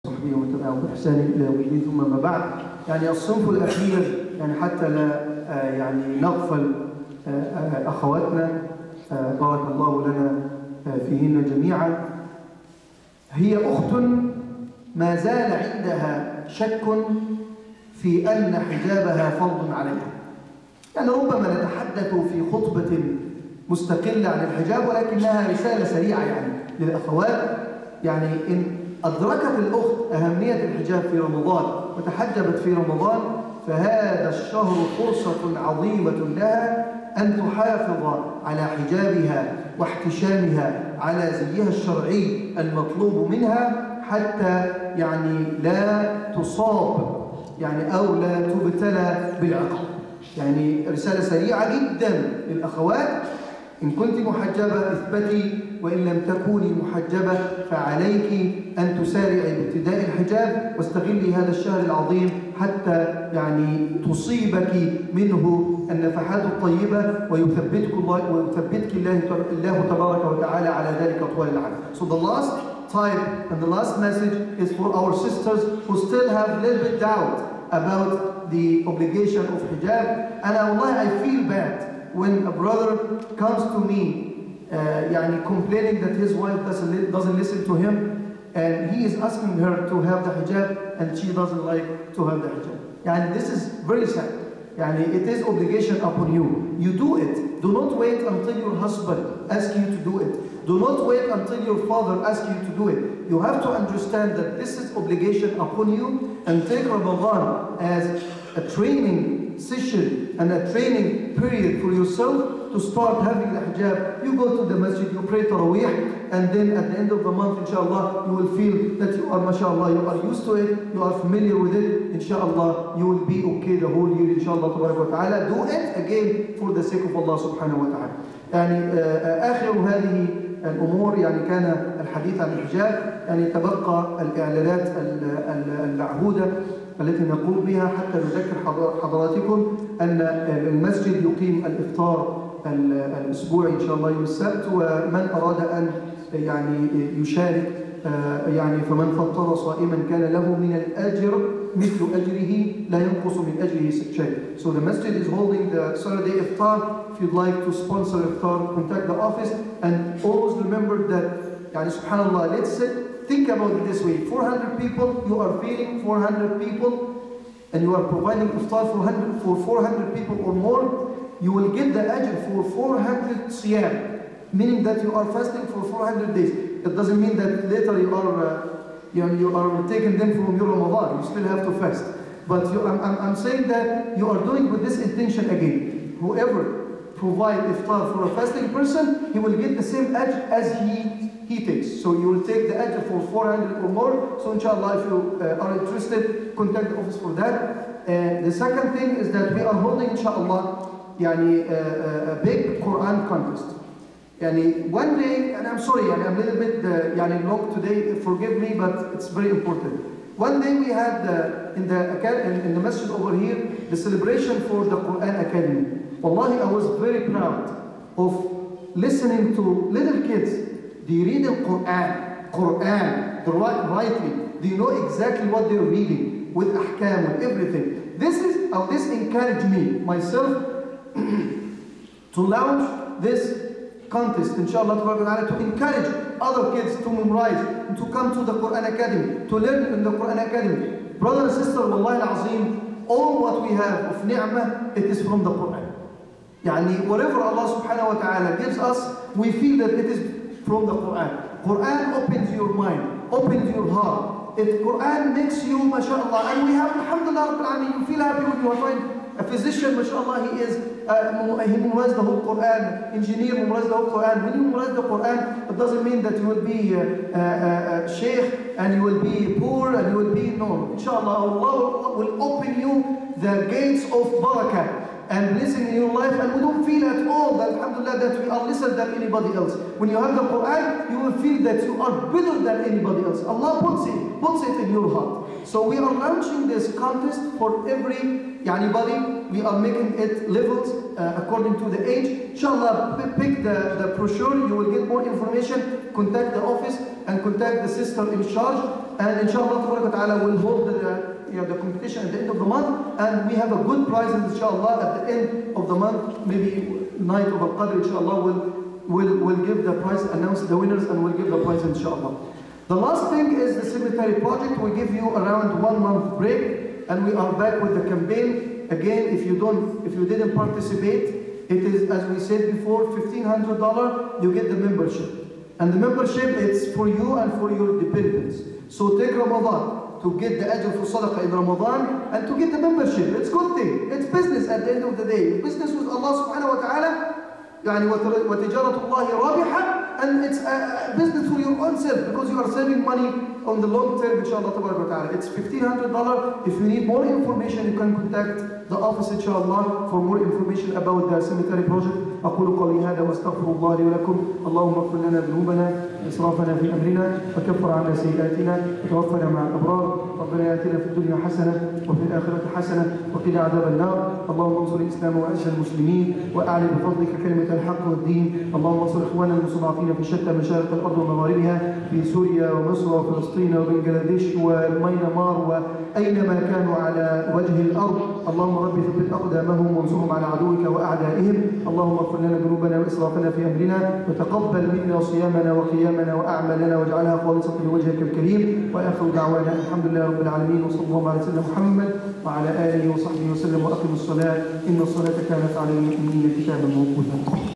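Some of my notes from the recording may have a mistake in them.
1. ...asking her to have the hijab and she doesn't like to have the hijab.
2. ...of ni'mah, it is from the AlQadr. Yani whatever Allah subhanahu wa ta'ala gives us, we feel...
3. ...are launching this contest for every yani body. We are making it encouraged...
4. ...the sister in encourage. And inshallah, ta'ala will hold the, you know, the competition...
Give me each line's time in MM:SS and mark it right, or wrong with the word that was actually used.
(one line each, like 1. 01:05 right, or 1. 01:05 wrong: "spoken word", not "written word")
1. 01:29 right
2. 04:04 wrong: "Quran", not "AlQadr"
3. 04:45 wrong: "leveled", not "encouraged"
4. 04:57 wrong: "charge", not "encourage".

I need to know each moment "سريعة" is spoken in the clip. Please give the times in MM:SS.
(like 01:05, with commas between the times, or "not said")
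00:25, 00:51.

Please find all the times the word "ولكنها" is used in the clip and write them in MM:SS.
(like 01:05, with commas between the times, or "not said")
00:24.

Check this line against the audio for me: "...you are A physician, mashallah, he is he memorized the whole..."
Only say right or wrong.
right.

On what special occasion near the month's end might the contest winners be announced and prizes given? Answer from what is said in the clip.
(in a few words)
Night of Al-Qadr.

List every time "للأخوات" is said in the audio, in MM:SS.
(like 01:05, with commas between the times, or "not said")
00:26, 00:52.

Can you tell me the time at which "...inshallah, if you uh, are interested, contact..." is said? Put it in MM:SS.
03:14.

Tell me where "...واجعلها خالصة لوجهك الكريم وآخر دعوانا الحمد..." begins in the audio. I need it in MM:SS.
06:26.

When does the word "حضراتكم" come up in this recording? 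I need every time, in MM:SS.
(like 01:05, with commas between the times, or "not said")
02:19.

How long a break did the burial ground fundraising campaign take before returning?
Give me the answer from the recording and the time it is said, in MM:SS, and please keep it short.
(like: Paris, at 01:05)
One month, at 05:15.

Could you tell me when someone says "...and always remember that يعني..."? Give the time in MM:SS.
02:39.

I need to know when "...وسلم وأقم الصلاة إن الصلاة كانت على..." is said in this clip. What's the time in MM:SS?
06:33.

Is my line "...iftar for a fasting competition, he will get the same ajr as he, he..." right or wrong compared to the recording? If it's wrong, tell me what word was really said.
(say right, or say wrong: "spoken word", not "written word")
wrong: "person", not "competition".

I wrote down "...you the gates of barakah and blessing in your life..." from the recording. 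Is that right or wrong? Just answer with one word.
right.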